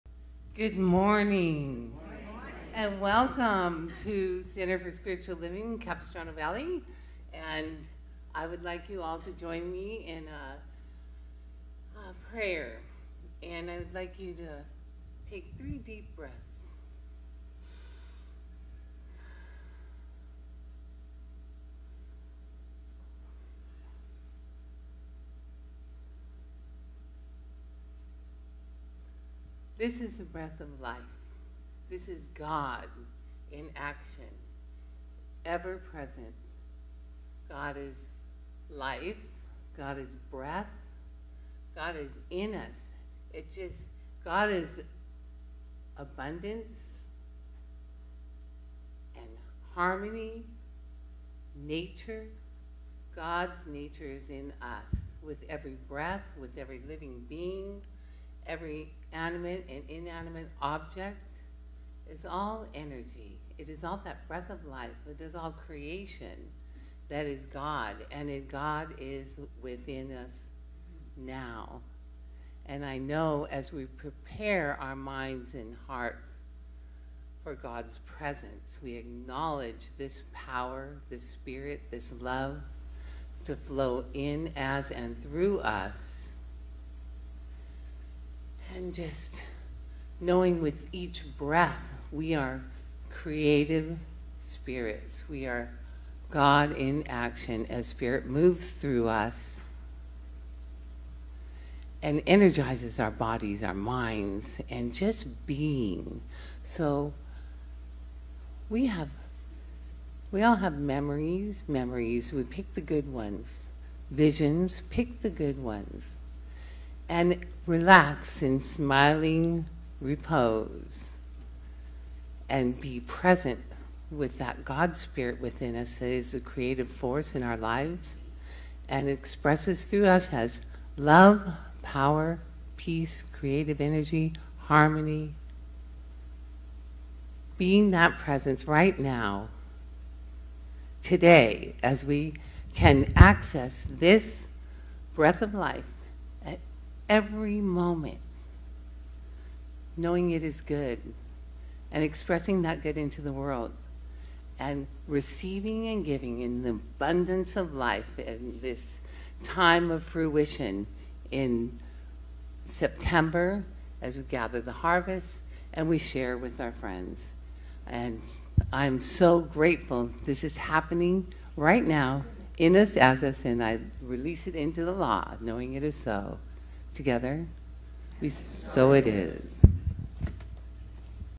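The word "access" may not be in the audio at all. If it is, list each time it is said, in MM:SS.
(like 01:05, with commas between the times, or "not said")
02:23.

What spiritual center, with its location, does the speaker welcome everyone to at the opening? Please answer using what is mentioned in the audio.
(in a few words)
Center for Spiritual Living, Capistrano Valley.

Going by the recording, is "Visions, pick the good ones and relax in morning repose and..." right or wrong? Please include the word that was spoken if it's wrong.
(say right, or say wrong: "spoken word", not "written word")
wrong: "smiling", not "morning".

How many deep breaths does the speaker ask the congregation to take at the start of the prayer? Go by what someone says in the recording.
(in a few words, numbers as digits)
3.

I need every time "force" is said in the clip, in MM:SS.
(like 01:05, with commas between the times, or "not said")
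02:06.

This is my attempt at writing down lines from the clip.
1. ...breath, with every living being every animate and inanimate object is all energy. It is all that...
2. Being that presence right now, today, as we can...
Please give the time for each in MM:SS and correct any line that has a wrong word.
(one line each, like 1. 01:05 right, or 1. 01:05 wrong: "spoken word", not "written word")
1. 00:55 right
2. 02:17 right.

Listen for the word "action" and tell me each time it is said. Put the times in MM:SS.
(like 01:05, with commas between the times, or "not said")
00:33, 01:37.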